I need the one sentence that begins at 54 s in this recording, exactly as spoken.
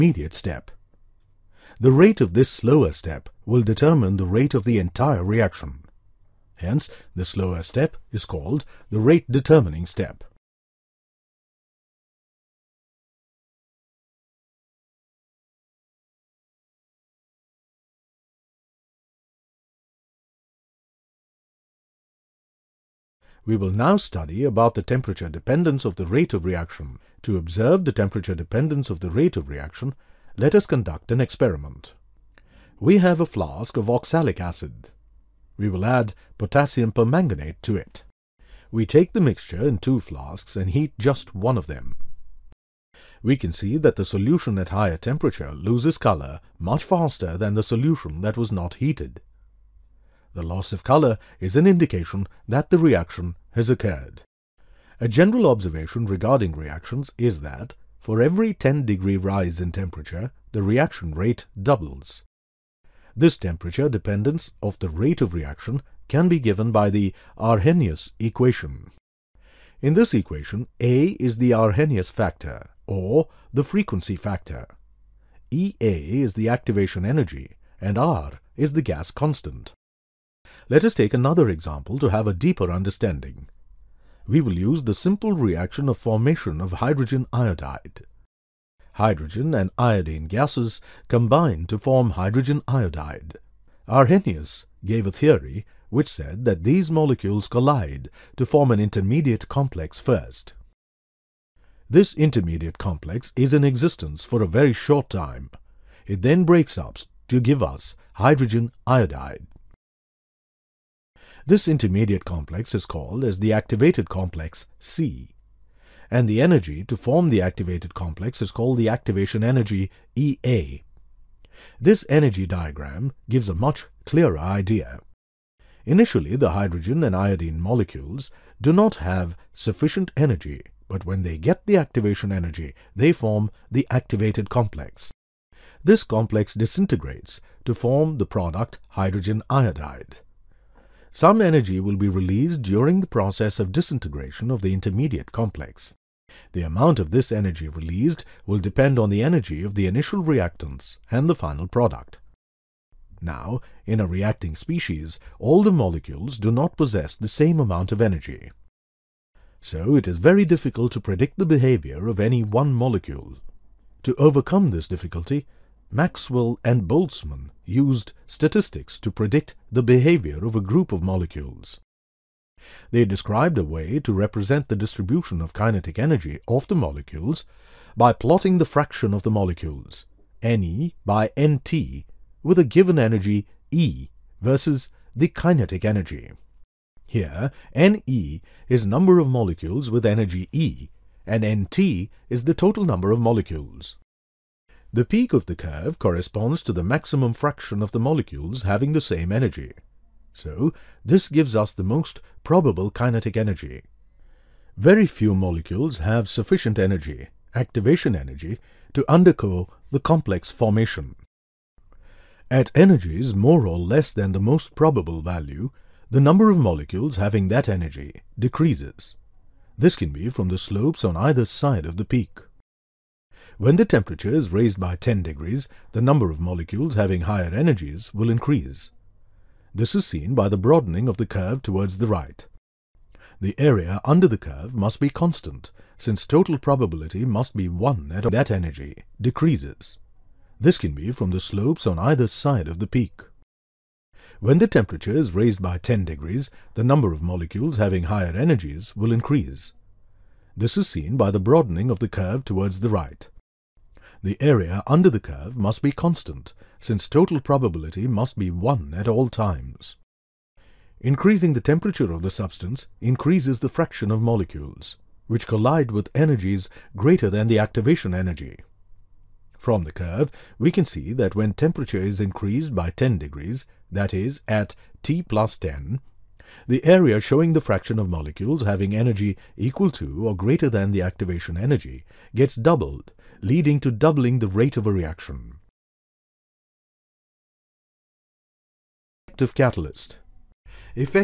A general observation regarding reactions is that, for every 10 degree rise in temperature, the reaction rate doubles.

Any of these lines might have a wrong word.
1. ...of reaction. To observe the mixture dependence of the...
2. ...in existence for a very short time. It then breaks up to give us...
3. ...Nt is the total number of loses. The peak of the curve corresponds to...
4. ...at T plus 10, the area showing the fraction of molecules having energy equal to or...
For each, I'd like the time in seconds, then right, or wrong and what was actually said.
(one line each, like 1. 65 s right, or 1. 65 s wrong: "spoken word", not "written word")
1. 26 s wrong: "temperature", not "mixture"
2. 103 s right
3. 191 s wrong: "molecules", not "loses"
4. 274 s right.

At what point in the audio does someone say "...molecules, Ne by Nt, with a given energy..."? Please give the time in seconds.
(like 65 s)
179 s.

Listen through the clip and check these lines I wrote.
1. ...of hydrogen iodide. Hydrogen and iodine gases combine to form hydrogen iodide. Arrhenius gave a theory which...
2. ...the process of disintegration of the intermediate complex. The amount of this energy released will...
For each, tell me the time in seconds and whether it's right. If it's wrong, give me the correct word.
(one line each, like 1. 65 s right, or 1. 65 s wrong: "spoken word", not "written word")
1. 86 s right
2. 142 s right.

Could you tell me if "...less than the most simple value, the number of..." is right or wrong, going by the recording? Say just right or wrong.
wrong.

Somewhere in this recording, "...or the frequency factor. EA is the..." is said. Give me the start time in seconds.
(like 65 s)
72 s.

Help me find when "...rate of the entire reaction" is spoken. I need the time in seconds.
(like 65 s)
4 s.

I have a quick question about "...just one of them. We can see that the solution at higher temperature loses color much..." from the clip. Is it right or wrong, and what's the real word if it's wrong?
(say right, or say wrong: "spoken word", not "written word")
right.